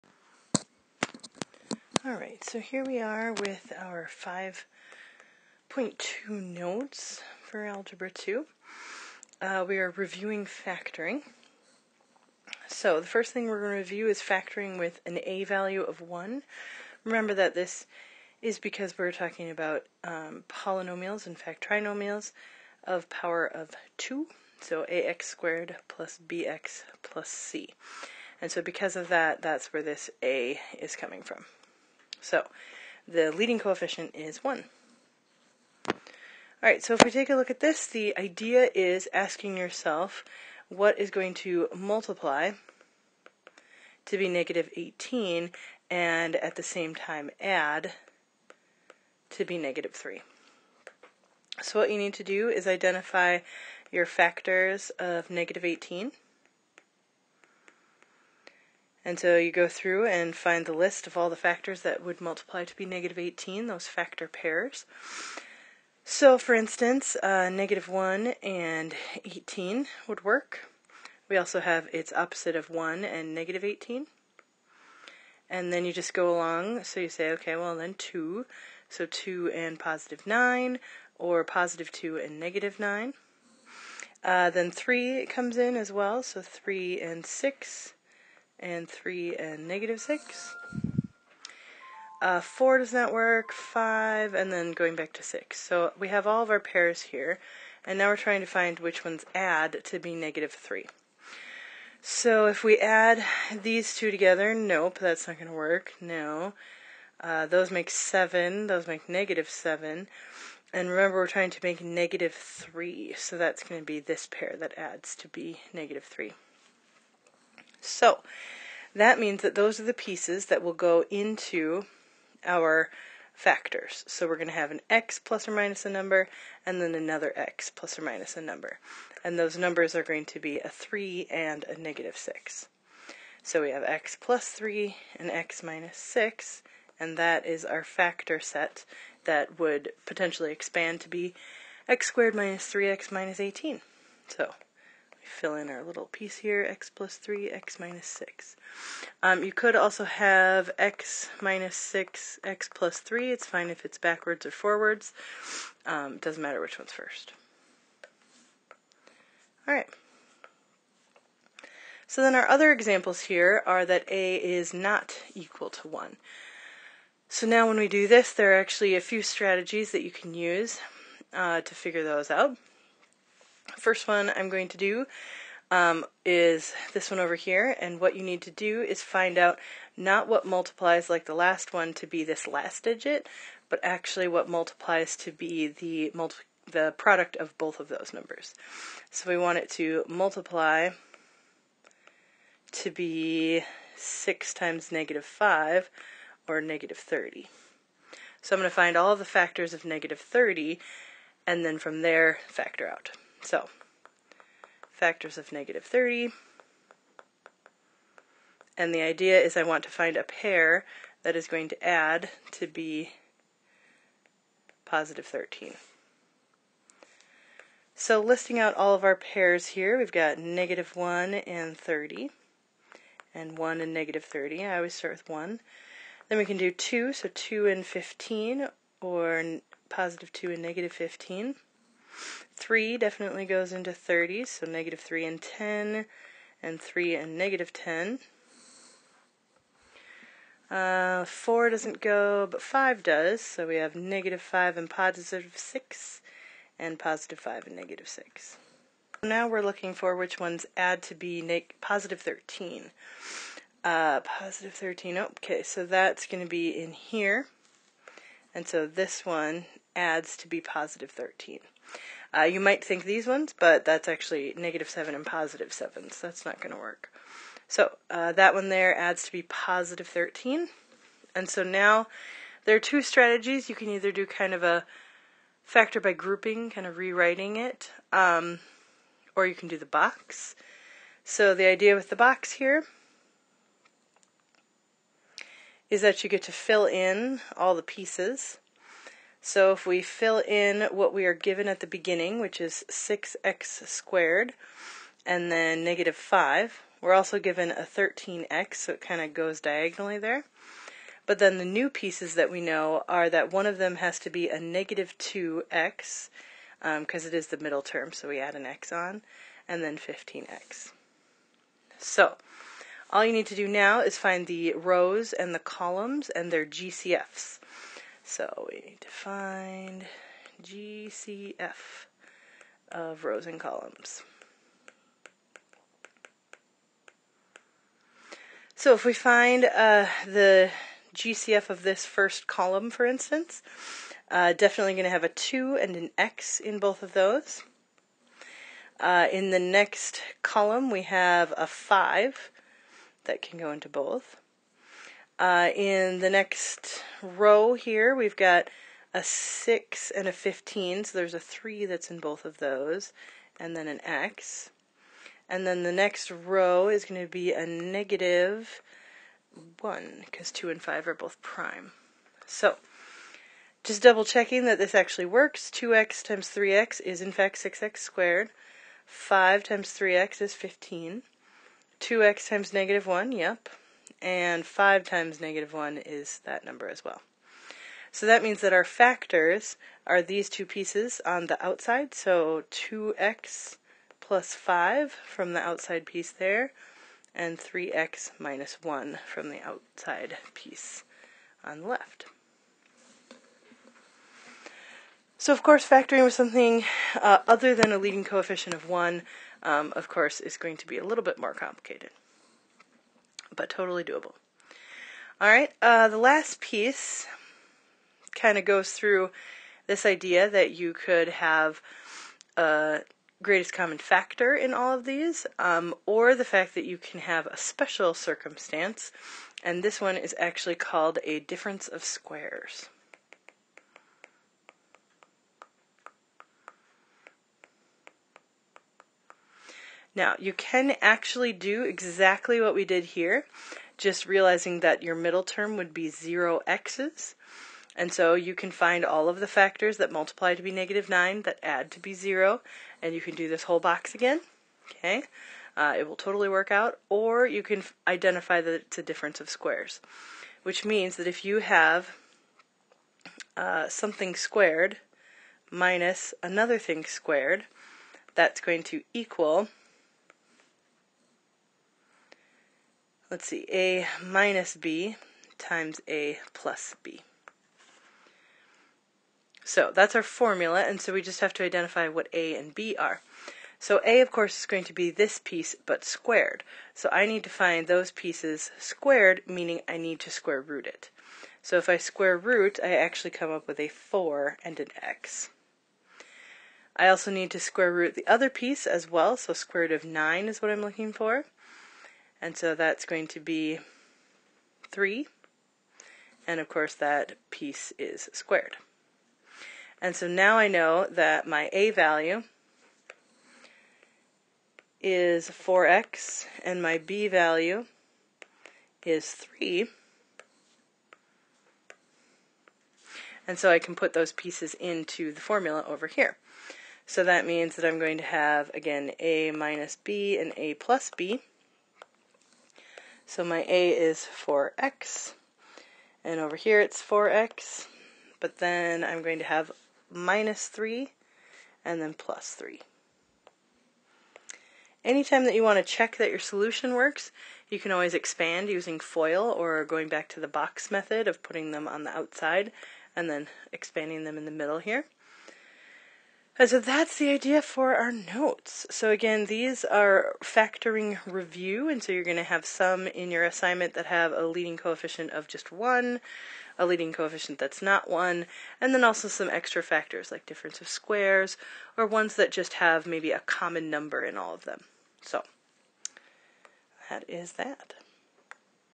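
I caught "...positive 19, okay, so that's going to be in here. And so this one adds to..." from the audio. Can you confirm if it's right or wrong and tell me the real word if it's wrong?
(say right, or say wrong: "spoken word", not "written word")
wrong: "13", not "19".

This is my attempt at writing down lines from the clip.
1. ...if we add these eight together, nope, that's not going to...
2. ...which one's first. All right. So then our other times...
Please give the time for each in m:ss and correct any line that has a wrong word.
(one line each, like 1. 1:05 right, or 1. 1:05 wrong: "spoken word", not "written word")
1. 1:42 wrong: "two", not "eight"
2. 2:36 wrong: "examples", not "times".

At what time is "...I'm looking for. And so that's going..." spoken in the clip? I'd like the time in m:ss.
8:10.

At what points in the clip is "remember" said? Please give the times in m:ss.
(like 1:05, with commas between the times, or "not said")
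0:17, 1:50.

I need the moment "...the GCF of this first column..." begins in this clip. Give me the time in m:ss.
5:30.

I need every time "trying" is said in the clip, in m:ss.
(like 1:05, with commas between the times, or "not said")
1:38, 1:51.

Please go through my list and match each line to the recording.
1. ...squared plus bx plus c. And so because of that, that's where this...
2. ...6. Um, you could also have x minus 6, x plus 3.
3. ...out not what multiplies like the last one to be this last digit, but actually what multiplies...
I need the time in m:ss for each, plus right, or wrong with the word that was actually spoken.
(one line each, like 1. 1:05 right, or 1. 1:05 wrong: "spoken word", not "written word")
1. 0:25 right
2. 2:28 right
3. 2:59 right.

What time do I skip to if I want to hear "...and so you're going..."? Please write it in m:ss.
9:11.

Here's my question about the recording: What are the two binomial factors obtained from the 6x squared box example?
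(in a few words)
2x + 5 and 3x - 1.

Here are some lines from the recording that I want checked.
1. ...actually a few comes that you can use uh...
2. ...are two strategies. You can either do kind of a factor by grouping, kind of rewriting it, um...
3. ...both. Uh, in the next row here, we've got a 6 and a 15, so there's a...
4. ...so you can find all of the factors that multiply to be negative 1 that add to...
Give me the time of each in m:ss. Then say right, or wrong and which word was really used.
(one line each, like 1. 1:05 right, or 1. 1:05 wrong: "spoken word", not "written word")
1. 2:48 wrong: "strategies", not "comes"
2. 4:32 right
3. 5:43 right
4. 7:18 wrong: "9", not "1".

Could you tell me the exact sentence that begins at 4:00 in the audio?
Uh, 4 doesn't go, but 5 does, so we have negative 5 and positive 6, and positive 5 and negative 6.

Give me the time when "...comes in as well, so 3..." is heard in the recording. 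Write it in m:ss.
1:25.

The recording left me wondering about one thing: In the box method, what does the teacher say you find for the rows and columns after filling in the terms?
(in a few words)
GCFs.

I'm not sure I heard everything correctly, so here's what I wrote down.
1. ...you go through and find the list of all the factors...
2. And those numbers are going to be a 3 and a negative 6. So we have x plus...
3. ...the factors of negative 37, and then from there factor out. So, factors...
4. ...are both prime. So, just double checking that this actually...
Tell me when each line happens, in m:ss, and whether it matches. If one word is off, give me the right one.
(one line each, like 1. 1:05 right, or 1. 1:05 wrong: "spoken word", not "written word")
1. 0:59 right
2. 2:09 right
3. 3:19 wrong: "30", not "37"
4. 6:01 right.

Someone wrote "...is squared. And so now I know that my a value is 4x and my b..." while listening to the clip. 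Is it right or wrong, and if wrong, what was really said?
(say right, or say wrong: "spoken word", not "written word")
right.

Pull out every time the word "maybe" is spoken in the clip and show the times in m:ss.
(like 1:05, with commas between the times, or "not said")
9:23.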